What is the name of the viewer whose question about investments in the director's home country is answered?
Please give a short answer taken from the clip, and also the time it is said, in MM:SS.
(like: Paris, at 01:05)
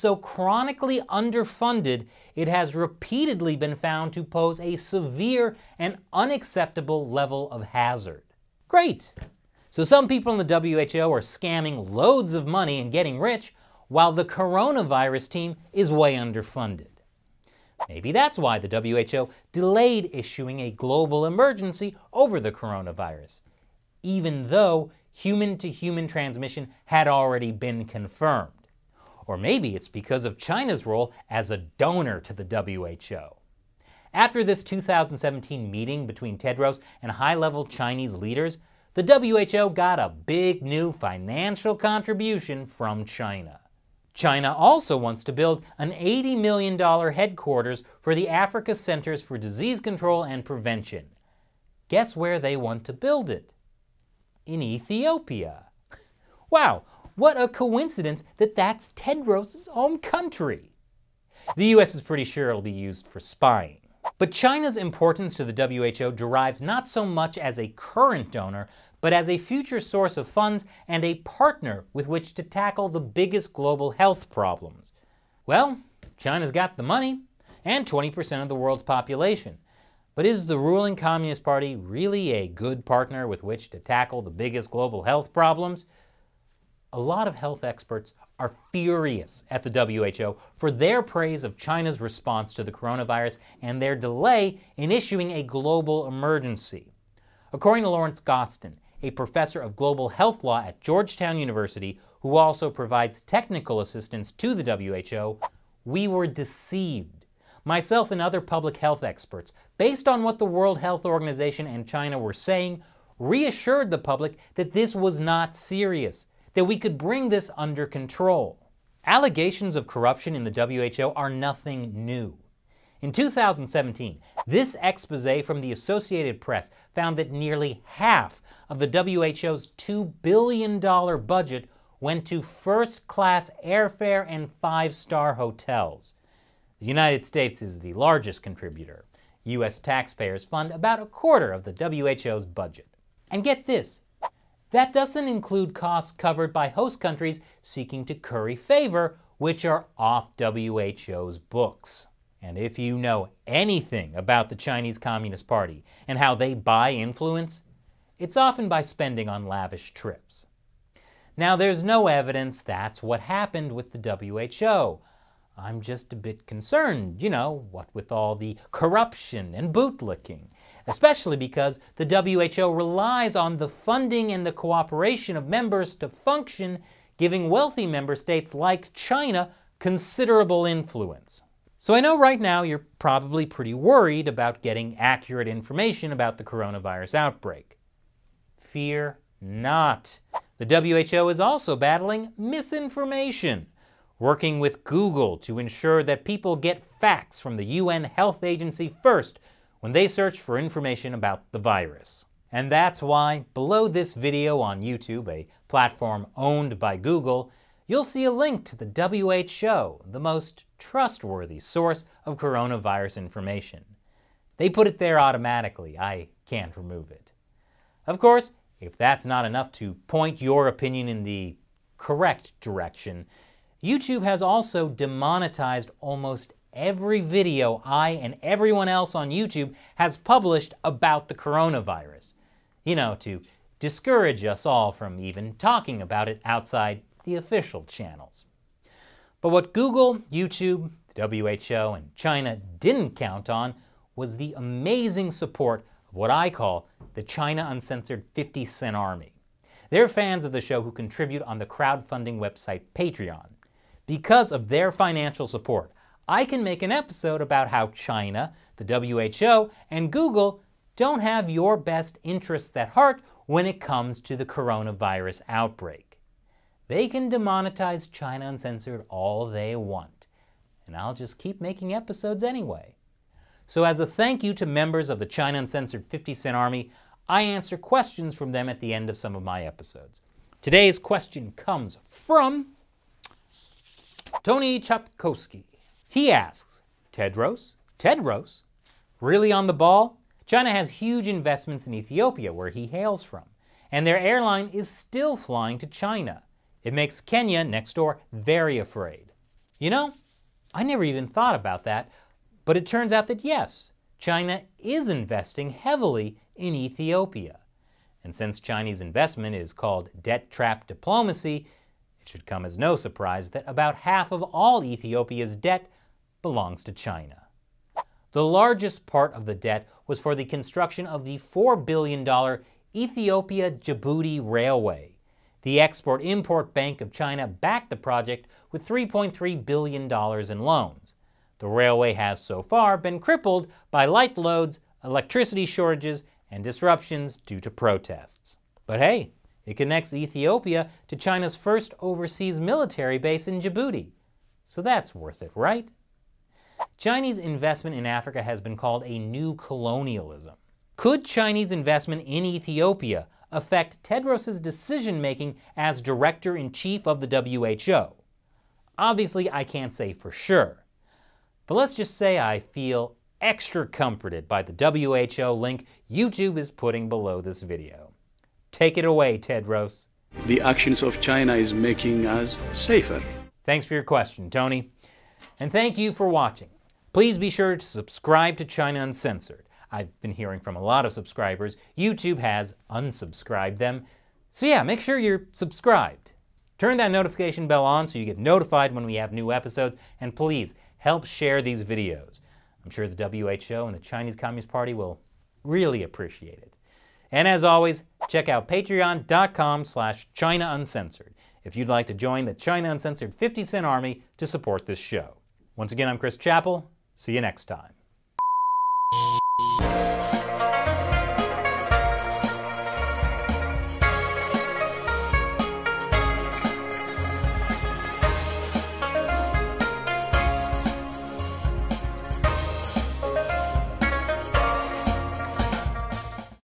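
Tony Chapkowski, at 04:44.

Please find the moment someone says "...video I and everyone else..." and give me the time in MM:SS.
03:47.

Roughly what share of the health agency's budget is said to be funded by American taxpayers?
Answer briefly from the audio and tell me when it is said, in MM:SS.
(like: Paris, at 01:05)
a quarter, at 02:20.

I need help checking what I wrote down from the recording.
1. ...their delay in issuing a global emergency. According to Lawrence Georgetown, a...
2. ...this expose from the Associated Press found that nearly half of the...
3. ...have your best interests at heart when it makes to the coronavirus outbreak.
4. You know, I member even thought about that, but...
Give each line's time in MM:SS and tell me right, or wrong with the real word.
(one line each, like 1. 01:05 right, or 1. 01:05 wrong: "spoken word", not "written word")
1. 01:33 wrong: "Gostin", not "Georgetown"
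2. 02:04 right
3. 04:21 wrong: "comes", not "makes"
4. 04:59 wrong: "never", not "member".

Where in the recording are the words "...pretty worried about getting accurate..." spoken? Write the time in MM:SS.
03:03.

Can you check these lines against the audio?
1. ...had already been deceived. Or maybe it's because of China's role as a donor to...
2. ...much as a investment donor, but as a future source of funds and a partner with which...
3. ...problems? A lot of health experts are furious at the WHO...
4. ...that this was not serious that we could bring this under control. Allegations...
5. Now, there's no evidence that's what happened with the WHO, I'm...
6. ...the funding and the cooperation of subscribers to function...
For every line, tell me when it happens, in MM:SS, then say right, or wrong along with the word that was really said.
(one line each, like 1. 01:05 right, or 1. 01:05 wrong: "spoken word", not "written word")
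1. 00:26 wrong: "confirmed", not "deceived"
2. 01:07 wrong: "current", not "investment"
3. 01:25 right
4. 01:54 right
5. 02:41 right
6. 02:53 wrong: "members", not "subscribers".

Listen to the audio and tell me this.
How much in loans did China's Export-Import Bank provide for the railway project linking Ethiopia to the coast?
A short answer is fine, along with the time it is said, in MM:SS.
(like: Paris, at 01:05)
$3.3 billion, at 05:28.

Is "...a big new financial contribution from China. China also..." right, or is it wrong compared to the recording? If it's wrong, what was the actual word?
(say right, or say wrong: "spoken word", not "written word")
right.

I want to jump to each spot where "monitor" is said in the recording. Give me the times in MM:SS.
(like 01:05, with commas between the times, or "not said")
not said.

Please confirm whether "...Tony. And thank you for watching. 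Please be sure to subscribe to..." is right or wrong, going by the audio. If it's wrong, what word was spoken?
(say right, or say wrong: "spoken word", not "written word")
right.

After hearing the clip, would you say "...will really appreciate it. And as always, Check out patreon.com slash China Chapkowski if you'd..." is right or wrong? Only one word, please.
wrong.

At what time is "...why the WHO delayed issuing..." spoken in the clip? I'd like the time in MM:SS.
00:18.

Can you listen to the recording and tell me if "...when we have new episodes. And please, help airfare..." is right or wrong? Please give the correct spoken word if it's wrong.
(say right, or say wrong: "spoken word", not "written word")
wrong: "share", not "airfare".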